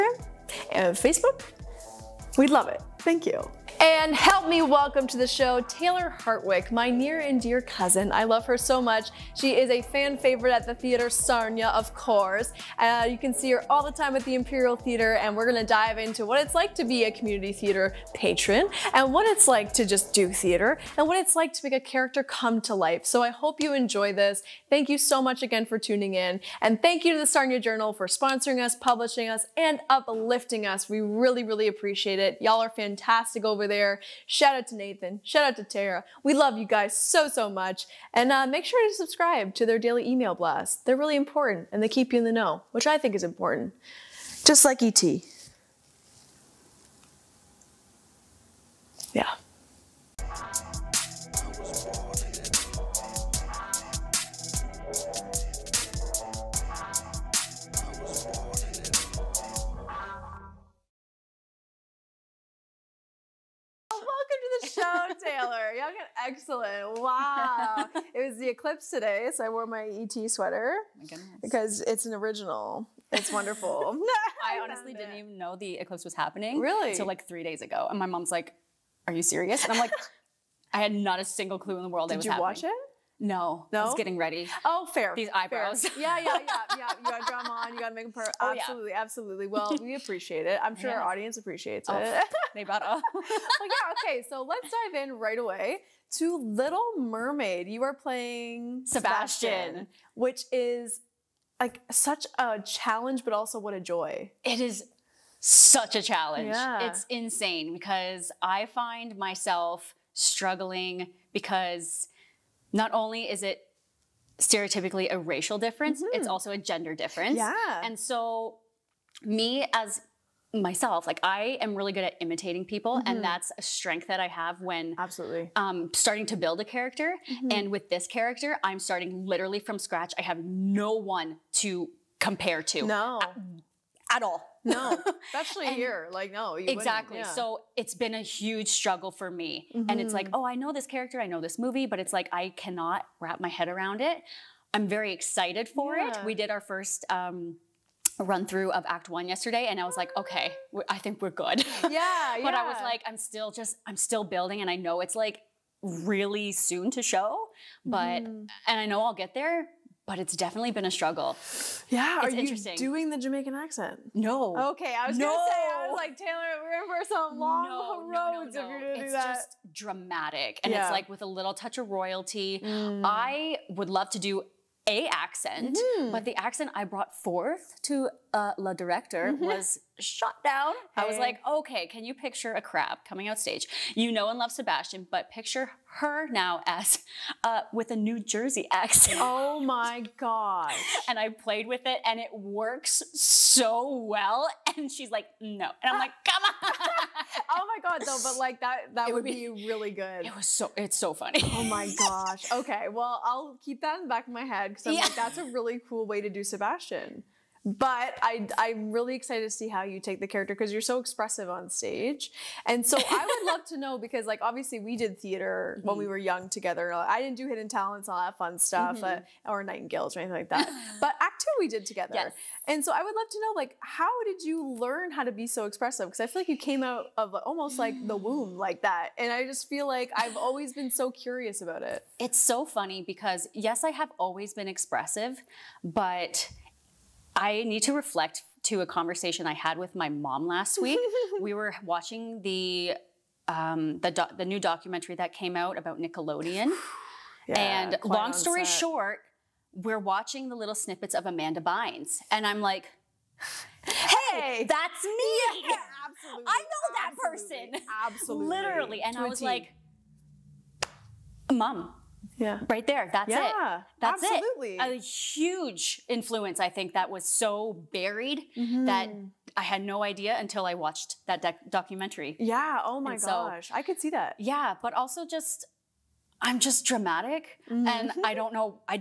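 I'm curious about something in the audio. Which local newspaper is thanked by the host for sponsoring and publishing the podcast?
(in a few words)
Sarnia Journal.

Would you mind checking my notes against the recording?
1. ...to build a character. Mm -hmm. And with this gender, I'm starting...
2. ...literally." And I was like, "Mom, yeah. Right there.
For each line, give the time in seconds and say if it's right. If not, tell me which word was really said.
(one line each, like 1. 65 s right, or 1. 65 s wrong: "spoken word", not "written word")
1. 126 s wrong: "character", not "gender"
2. 258 s right.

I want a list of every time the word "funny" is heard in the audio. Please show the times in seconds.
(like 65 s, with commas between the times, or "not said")
201 s, 232 s.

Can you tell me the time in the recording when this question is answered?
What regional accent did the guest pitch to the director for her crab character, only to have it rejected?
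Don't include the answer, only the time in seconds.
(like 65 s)
187 s.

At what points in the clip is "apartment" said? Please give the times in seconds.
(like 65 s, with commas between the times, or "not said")
not said.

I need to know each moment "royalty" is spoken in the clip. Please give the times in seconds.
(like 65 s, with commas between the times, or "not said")
171 s.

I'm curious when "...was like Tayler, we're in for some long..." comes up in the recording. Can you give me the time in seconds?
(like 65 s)
165 s.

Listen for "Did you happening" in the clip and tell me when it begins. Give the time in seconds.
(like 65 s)
82 s.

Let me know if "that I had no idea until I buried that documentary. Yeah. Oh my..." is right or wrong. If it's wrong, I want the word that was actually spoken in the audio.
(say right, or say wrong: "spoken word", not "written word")
wrong: "watched", not "buried".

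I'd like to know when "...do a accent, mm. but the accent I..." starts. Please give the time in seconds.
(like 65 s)
174 s.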